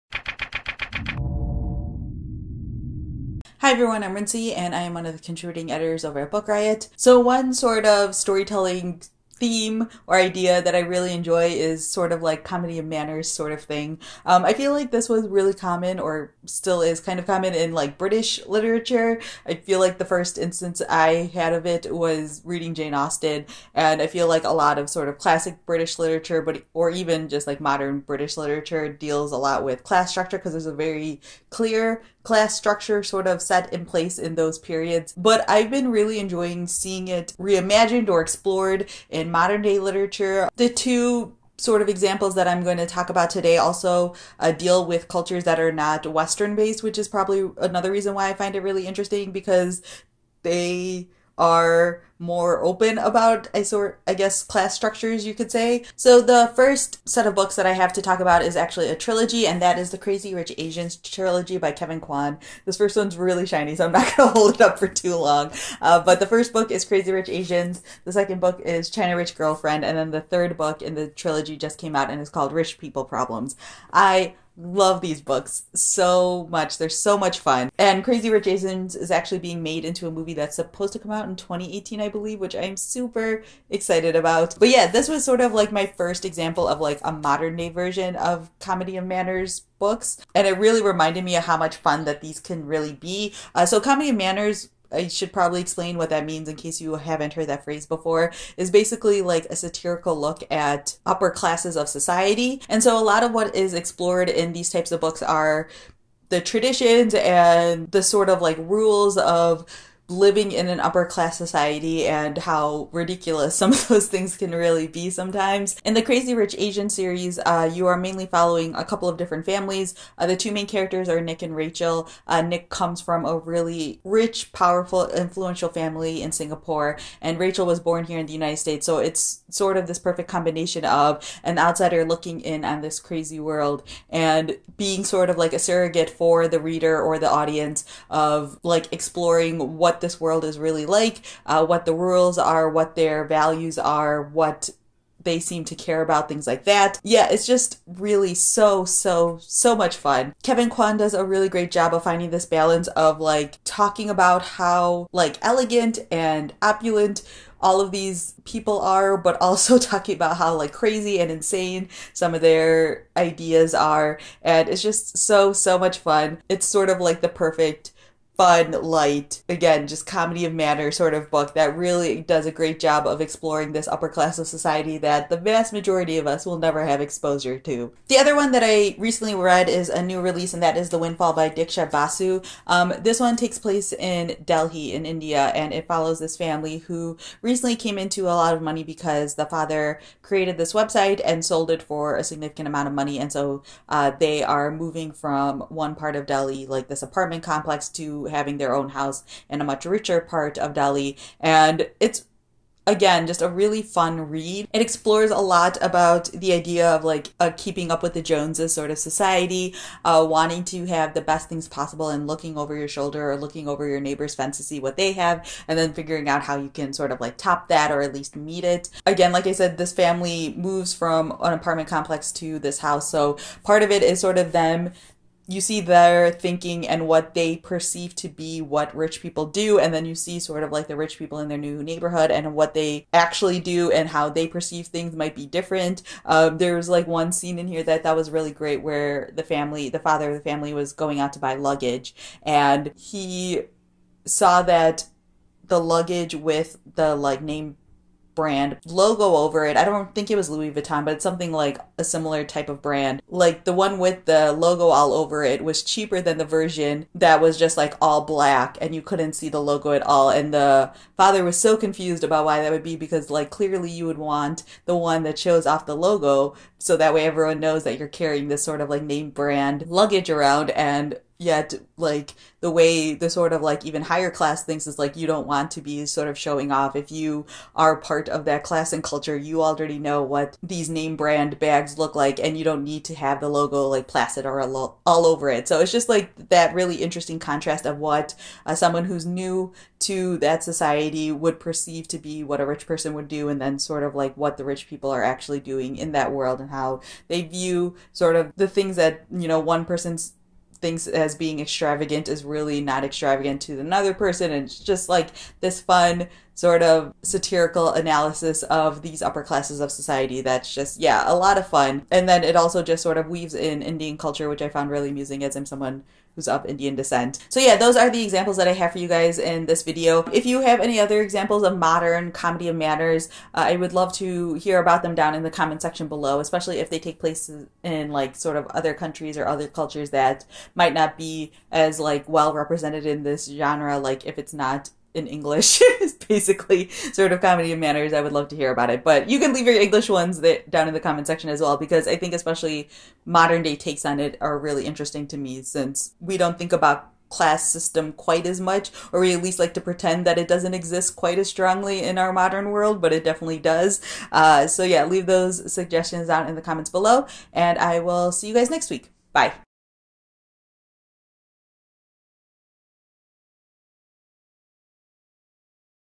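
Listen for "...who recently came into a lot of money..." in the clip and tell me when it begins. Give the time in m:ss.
3:06.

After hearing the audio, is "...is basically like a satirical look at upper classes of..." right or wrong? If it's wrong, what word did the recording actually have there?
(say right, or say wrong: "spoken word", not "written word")
right.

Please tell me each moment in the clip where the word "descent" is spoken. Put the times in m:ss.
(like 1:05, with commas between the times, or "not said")
5:16.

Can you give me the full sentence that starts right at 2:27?
Yeah, it's just really so, so, so much fun.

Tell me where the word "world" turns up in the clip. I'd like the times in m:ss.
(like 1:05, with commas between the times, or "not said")
2:13, 2:20, 4:56, 5:52.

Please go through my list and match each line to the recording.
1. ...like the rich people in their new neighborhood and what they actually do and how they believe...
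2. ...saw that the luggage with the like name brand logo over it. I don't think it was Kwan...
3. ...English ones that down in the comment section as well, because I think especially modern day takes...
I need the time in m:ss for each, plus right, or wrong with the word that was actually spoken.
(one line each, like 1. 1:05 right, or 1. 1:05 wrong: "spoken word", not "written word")
1. 3:50 wrong: "perceive", not "believe"
2. 4:04 wrong: "Louis", not "Kwan"
3. 5:39 right.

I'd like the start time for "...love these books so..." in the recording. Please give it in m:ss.
1:14.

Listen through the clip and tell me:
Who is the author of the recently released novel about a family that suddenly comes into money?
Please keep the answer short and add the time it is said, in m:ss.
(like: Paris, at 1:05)
Diksha Basu, at 3:01.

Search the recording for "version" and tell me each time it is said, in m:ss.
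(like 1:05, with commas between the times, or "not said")
1:27, 4:16.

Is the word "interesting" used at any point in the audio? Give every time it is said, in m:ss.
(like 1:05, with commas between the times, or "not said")
0:48, 4:46, 5:44.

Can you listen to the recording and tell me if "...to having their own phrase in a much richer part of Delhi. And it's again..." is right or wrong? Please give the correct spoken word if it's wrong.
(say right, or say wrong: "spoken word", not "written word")
wrong: "house", not "phrase".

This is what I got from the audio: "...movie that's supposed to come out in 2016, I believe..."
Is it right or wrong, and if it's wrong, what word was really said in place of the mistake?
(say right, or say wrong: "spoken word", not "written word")
wrong: "2018", not "2016".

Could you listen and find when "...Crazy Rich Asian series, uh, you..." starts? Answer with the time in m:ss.
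1:56.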